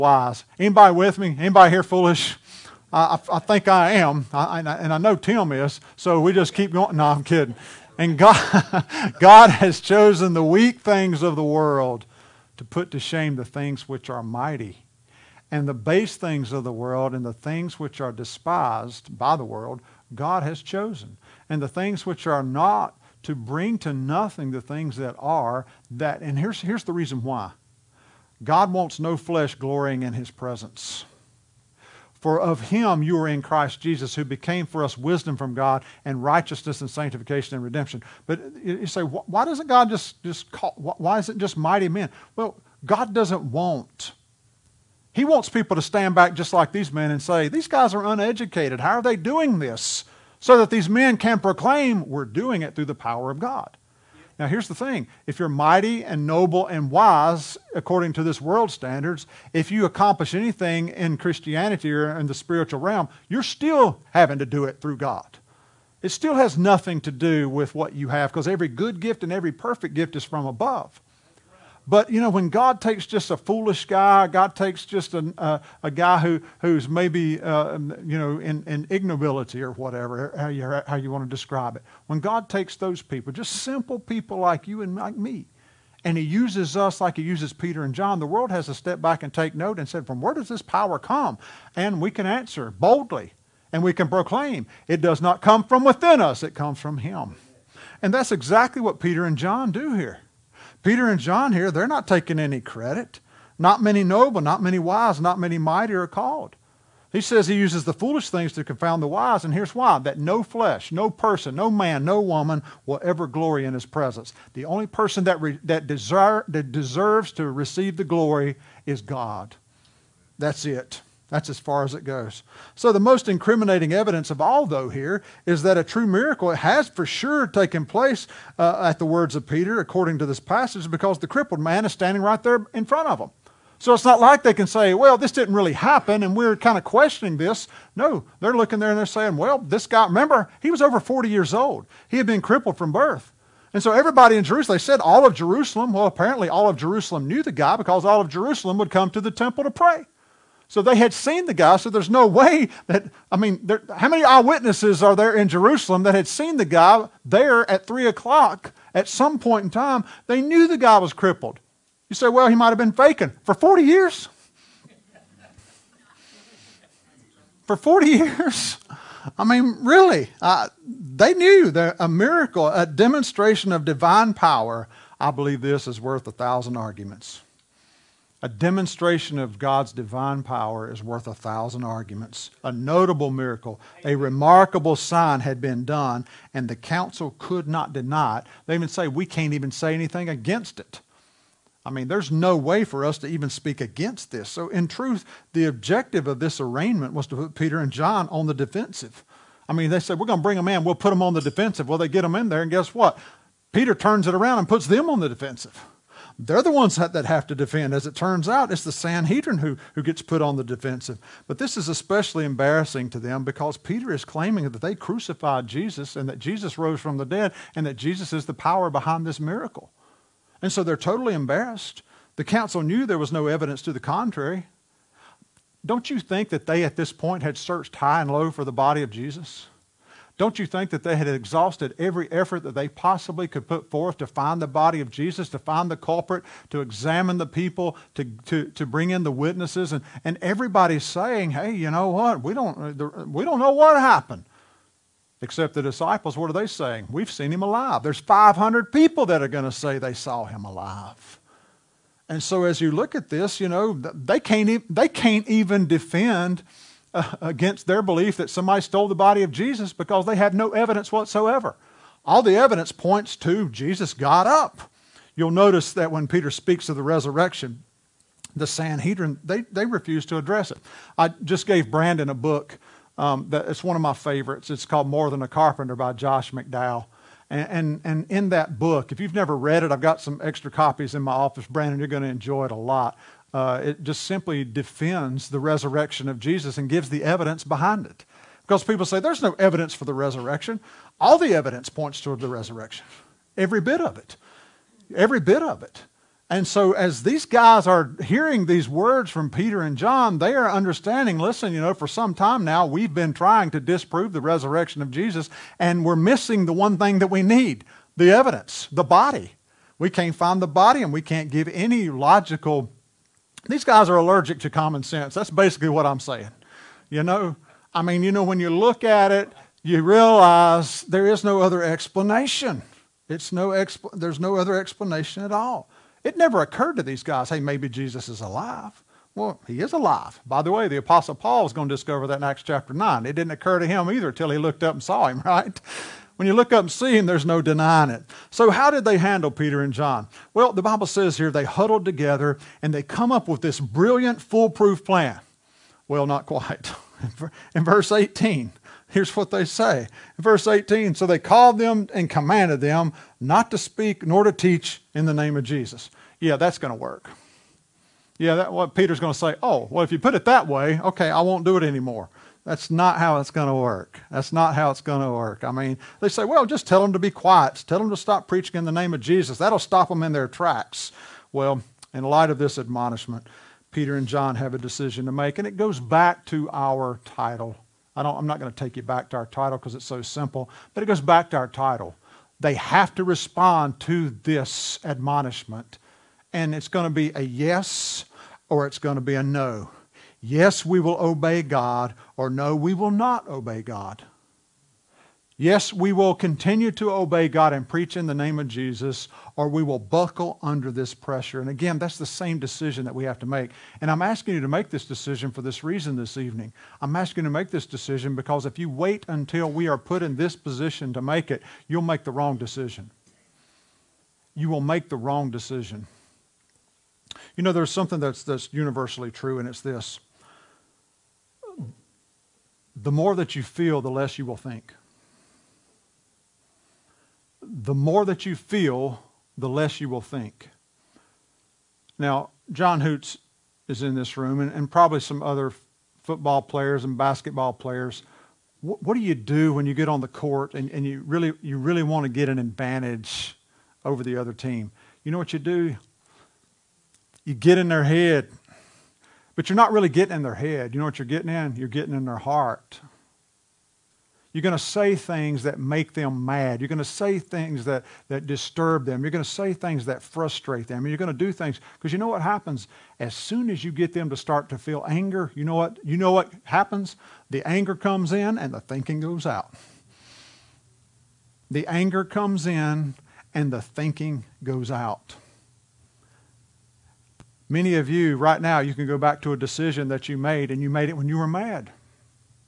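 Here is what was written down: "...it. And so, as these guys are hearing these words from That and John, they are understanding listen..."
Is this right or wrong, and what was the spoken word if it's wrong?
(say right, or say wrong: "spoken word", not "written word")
wrong: "Peter", not "That".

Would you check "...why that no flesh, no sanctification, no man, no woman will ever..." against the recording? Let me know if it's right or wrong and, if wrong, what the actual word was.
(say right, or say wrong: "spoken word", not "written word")
wrong: "person", not "sanctification".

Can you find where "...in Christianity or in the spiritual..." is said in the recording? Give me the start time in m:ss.
1:00.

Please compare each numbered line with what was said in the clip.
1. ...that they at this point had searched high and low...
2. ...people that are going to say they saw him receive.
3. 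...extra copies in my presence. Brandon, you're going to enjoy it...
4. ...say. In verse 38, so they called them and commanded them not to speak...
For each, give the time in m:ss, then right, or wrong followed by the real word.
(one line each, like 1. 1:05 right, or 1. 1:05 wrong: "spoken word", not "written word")
1. 3:46 right
2. 4:08 wrong: "alive", not "receive"
3. 4:40 wrong: "office", not "presence"
4. 5:49 wrong: "18", not "38".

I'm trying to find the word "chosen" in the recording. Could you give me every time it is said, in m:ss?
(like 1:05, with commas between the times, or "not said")
0:09, 0:20.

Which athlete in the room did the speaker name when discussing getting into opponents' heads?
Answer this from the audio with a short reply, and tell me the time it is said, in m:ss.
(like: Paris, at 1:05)
John Hoots, at 7:12.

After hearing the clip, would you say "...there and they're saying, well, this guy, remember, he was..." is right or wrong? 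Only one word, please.
right.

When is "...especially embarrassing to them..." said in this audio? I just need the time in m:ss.
3:31.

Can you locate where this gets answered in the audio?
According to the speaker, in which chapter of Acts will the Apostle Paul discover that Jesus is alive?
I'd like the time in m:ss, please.
5:32.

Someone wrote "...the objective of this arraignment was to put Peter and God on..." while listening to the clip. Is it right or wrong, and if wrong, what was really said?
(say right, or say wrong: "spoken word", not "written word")
wrong: "John", not "God".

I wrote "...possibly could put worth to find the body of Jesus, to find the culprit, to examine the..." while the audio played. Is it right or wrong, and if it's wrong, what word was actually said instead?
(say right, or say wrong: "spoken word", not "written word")
wrong: "forth", not "worth".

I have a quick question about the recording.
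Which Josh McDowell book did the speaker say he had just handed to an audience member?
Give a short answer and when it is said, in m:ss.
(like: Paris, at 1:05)
More Than a Carpenter, at 4:35.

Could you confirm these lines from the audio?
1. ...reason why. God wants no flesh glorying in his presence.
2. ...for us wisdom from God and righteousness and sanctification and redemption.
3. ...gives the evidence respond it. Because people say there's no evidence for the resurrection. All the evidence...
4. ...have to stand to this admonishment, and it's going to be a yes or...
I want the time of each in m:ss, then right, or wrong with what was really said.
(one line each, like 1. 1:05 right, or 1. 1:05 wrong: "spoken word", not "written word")
1. 0:26 right
2. 0:34 right
3. 4:46 wrong: "behind", not "respond"
4. 6:22 wrong: "respond", not "stand".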